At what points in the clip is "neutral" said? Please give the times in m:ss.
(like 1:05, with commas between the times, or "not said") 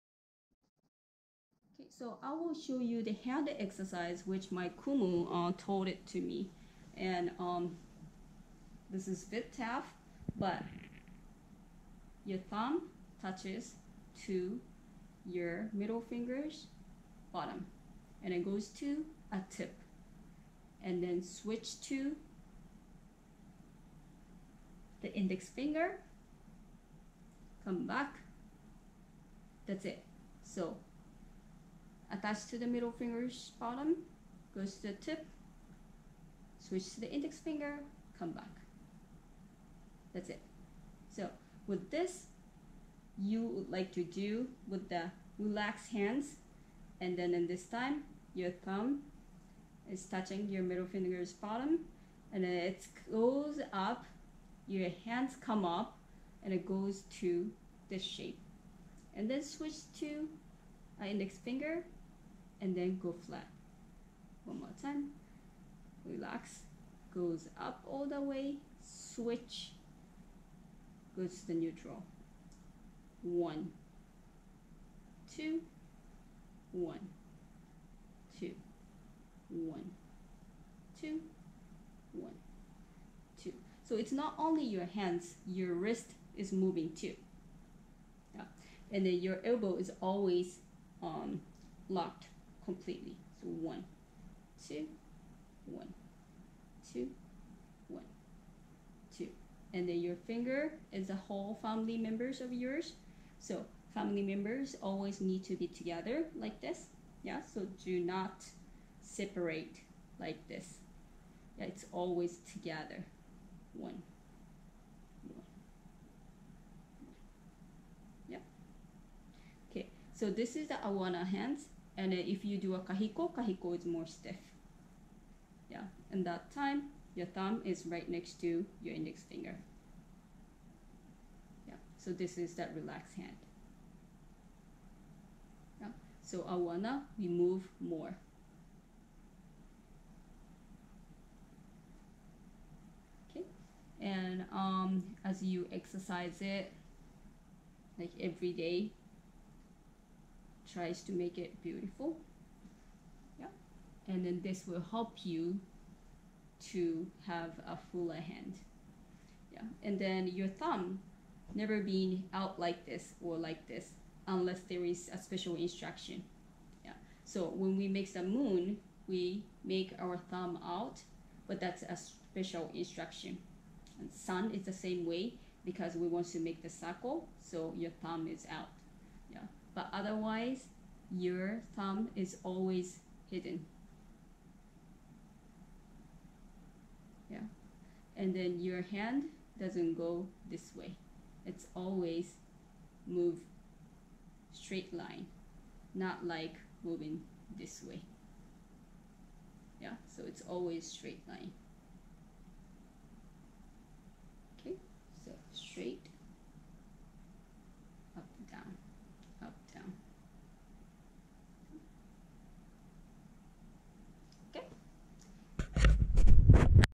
1:11.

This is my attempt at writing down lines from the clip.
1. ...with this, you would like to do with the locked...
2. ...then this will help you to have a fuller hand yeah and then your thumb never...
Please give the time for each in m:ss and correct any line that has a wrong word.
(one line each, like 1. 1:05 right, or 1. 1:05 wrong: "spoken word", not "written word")
1. 0:41 wrong: "relaxed", not "locked"
2. 2:34 right.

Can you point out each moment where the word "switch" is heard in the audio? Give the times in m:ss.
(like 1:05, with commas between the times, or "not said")
0:21, 0:36, 0:59, 1:08.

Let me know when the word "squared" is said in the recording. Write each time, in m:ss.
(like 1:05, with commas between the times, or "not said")
not said.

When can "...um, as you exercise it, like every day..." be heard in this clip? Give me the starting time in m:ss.
2:24.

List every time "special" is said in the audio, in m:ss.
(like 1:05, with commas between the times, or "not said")
2:45, 2:51.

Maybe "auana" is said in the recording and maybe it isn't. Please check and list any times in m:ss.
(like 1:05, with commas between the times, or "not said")
2:00, 2:16.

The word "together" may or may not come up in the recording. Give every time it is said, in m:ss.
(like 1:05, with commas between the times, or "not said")
1:45, 1:52.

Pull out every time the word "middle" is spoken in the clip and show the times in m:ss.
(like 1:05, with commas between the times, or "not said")
0:15, 0:32, 0:50.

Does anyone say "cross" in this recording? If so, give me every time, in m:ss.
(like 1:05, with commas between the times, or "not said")
not said.